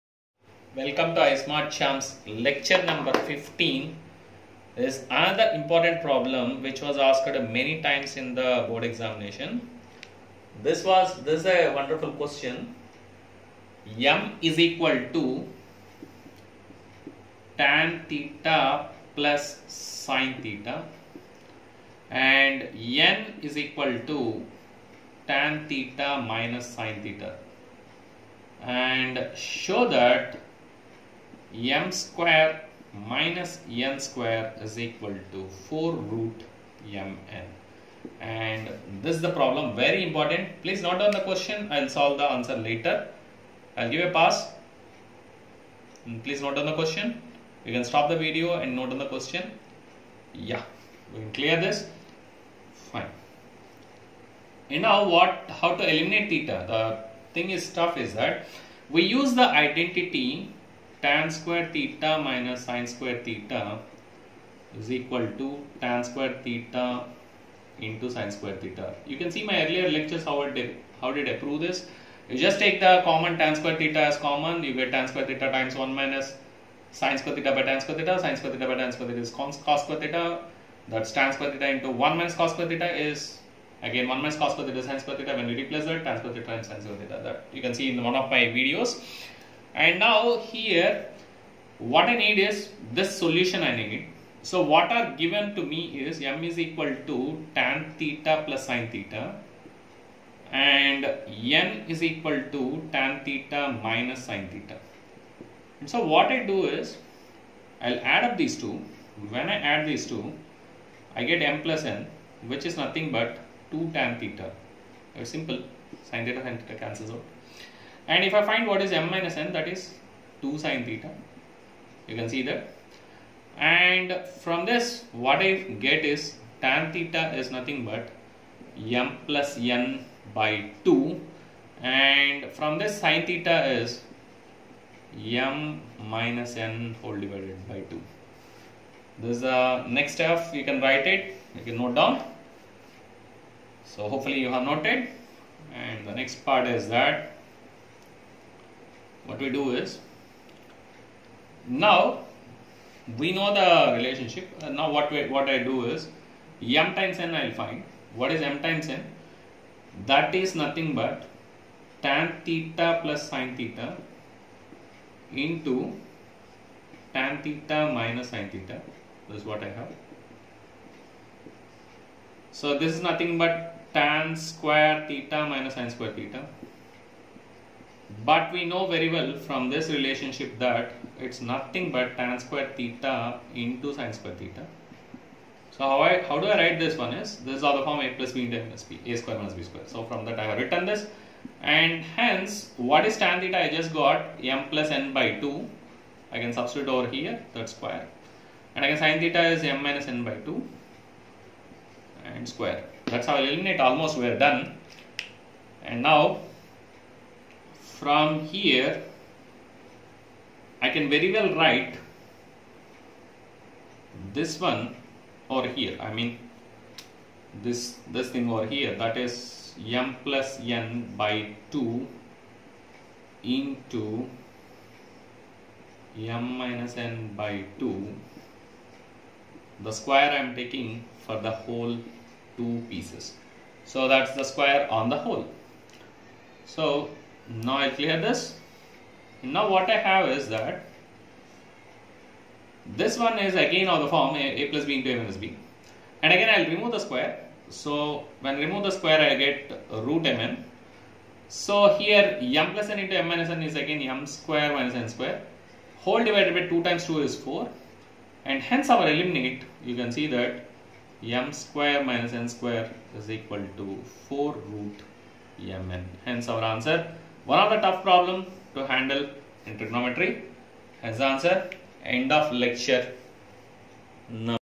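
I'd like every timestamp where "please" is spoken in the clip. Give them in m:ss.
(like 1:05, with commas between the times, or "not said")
0:40, 0:46.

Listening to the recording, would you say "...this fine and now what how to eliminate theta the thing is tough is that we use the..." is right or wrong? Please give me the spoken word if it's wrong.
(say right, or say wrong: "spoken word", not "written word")
right.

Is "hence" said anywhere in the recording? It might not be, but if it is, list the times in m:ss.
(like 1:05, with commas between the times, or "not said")
3:12, 4:18, 4:26.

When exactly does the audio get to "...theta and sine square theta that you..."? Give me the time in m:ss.
1:26.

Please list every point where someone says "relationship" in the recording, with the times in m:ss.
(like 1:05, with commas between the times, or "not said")
2:33, 2:59.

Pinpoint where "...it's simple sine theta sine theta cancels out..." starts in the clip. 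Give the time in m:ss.
1:55.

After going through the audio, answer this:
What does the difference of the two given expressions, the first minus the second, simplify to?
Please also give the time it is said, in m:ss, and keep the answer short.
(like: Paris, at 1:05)
2 sine theta, at 2:00.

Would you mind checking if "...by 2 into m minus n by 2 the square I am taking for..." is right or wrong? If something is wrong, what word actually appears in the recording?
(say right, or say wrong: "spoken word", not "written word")
right.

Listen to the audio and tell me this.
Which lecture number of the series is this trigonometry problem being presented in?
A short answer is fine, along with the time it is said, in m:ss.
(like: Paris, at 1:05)
15, at 0:02.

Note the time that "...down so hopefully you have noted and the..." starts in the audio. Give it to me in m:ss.
2:21.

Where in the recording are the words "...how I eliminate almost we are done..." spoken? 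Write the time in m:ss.
3:23.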